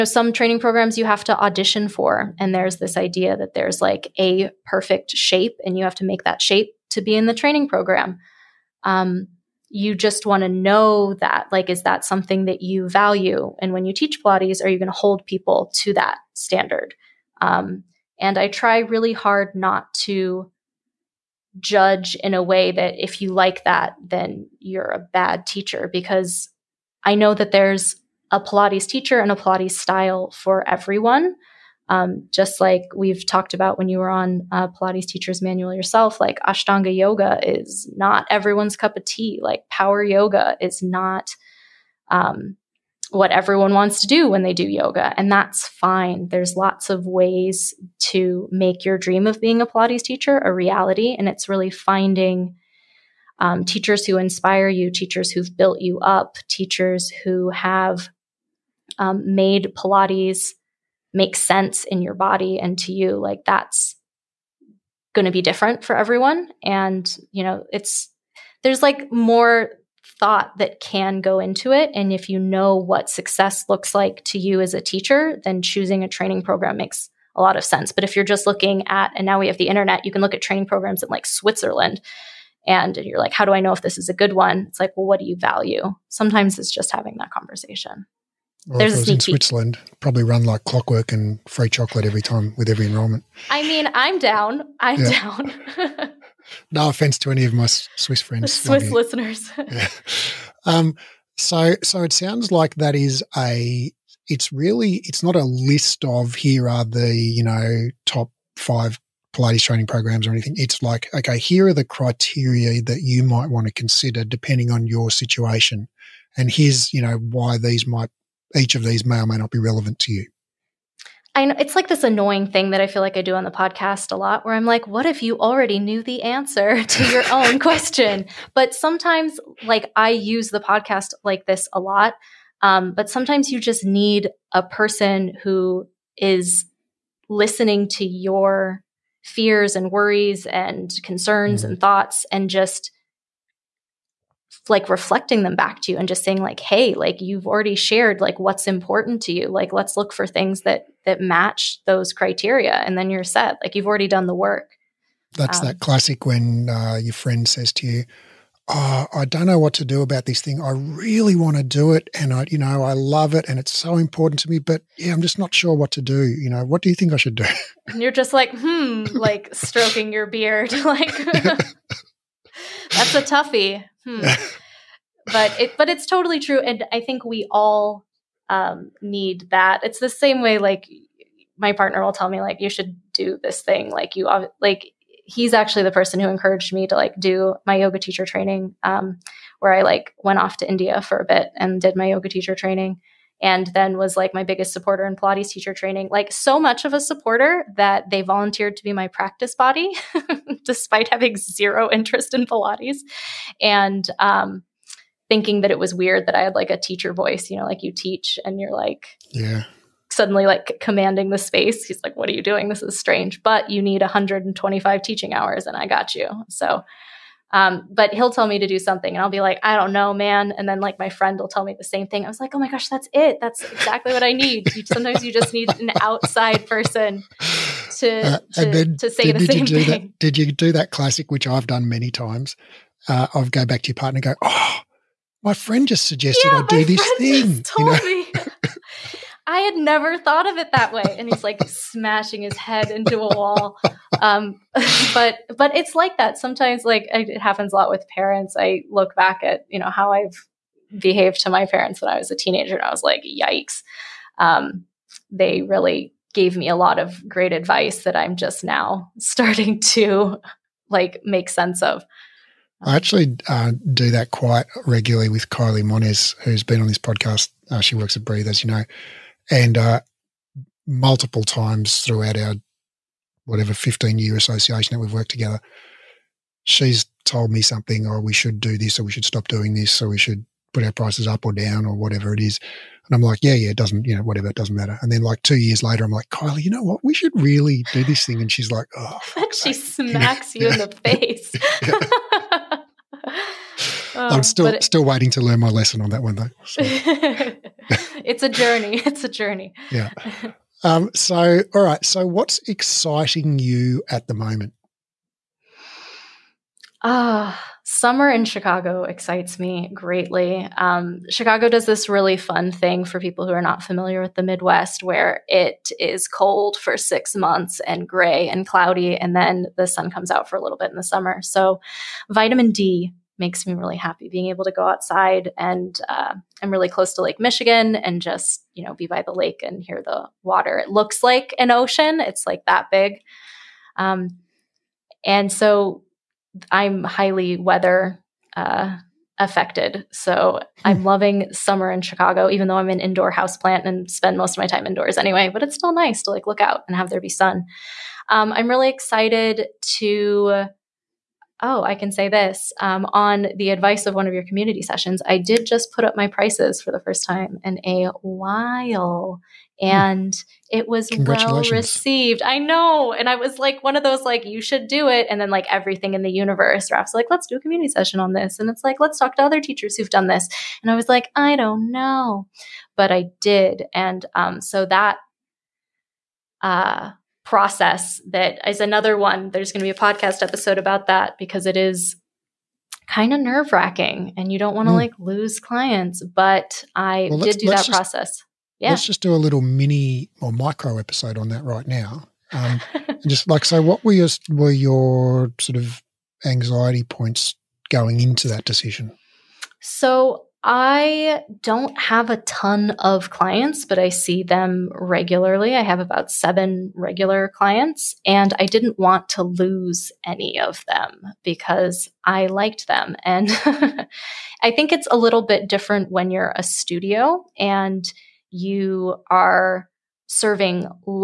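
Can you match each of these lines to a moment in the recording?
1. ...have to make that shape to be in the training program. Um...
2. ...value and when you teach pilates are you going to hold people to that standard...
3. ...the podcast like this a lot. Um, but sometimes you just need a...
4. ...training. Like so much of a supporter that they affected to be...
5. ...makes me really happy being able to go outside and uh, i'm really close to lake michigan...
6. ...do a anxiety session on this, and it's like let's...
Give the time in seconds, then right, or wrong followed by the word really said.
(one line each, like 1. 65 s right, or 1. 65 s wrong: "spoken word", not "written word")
1. 5 s right
2. 12 s right
3. 130 s right
4. 195 s wrong: "volunteered", not "affected"
5. 323 s right
6. 367 s wrong: "community", not "anxiety".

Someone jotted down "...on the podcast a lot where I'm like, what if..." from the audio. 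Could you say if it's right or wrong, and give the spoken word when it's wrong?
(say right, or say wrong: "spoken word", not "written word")
right.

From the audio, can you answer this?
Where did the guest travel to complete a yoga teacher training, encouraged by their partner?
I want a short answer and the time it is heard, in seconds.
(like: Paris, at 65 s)
India, at 190 s.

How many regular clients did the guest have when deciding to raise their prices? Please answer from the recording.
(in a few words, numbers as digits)
7.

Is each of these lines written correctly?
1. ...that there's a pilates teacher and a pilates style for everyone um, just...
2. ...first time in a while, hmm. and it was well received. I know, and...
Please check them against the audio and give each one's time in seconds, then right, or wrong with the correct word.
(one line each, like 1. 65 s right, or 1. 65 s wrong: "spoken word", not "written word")
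1. 27 s right
2. 357 s right.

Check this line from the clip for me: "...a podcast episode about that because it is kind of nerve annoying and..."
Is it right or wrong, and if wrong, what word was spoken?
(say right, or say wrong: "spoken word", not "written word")
wrong: "wracking", not "annoying".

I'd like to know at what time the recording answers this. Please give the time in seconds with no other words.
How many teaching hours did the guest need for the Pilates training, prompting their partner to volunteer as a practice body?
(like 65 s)
214 s.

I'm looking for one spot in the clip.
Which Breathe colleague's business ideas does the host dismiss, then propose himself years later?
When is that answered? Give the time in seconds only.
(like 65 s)
265 s.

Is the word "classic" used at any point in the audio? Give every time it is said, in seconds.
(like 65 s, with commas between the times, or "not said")
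155 s, 230 s.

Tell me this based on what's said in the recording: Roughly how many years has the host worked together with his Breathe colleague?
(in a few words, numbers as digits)
15.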